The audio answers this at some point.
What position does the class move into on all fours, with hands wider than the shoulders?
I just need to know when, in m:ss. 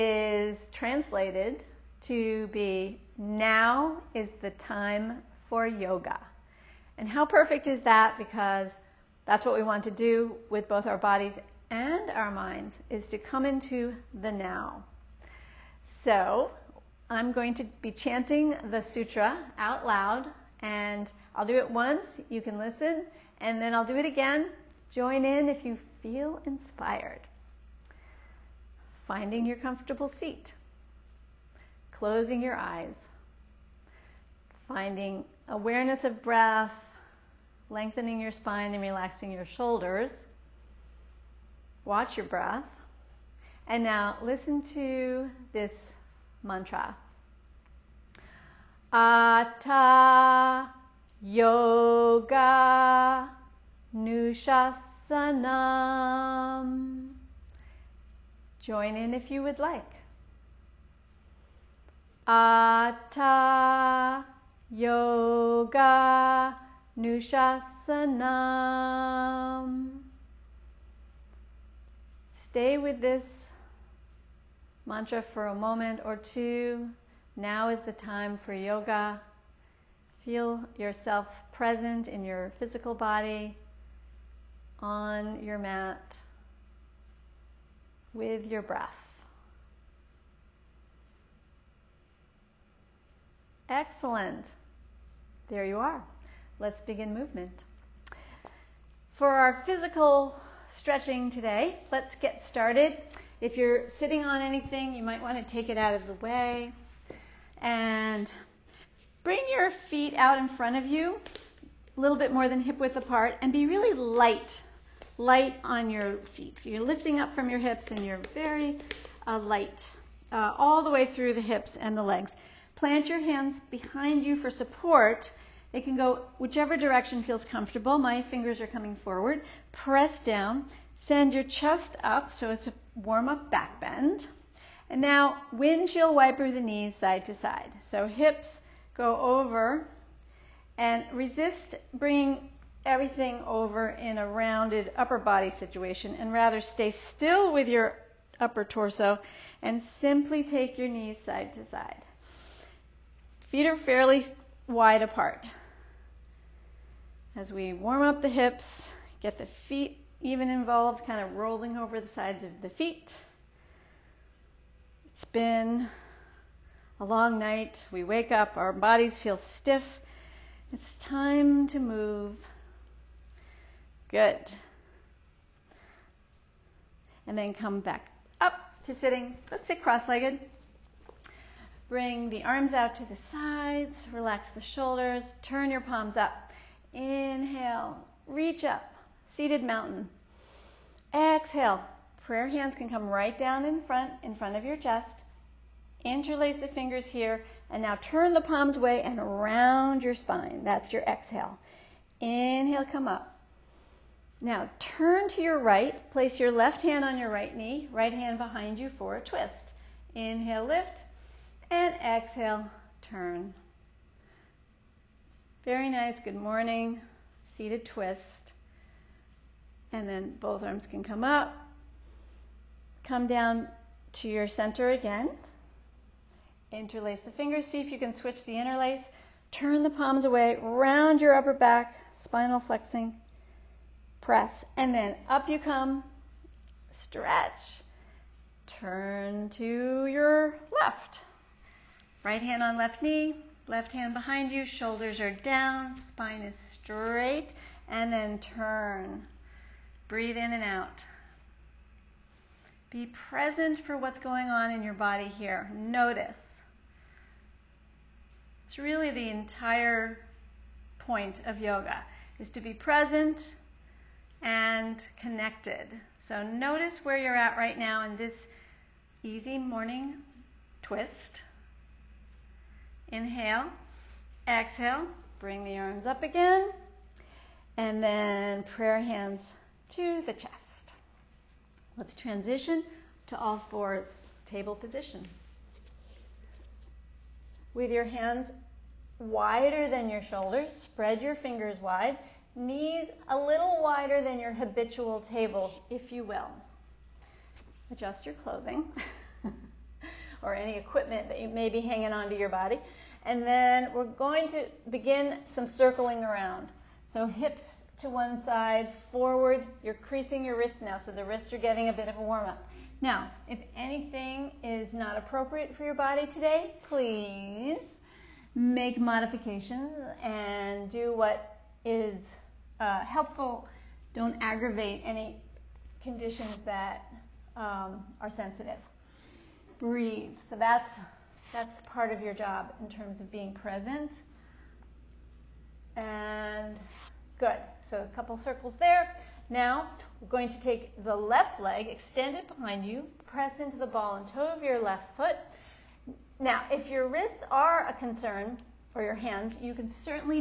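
4:44.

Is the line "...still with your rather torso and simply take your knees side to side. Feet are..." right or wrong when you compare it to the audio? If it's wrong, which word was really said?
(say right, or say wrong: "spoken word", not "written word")
wrong: "upper", not "rather".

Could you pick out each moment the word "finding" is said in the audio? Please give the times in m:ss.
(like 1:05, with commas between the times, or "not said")
0:29, 0:34.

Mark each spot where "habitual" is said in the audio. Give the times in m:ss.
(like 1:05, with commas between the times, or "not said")
4:54.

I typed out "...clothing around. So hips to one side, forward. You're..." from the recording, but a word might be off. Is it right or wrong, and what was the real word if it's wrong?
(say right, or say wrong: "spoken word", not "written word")
wrong: "circling", not "clothing".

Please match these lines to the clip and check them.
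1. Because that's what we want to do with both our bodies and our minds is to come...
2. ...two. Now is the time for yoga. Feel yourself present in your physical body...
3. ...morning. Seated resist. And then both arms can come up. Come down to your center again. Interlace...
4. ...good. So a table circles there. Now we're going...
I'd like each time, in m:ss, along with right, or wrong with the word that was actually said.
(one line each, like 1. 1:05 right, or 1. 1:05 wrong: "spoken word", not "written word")
1. 0:08 right
2. 1:16 right
3. 3:36 wrong: "twist", not "resist"
4. 5:37 wrong: "couple", not "table".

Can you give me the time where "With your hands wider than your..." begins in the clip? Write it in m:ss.
4:47.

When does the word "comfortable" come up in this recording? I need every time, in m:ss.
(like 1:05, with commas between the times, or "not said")
0:29, 2:07.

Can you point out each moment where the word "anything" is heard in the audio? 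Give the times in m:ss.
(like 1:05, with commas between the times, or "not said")
1:44, 5:13.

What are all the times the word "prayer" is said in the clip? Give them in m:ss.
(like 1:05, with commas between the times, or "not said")
3:12, 4:38.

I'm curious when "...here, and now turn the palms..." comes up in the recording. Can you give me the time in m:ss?
3:17.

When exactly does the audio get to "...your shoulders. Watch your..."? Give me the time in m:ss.
0:39.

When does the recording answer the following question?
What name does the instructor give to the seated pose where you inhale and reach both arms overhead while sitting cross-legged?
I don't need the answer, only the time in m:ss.
3:09.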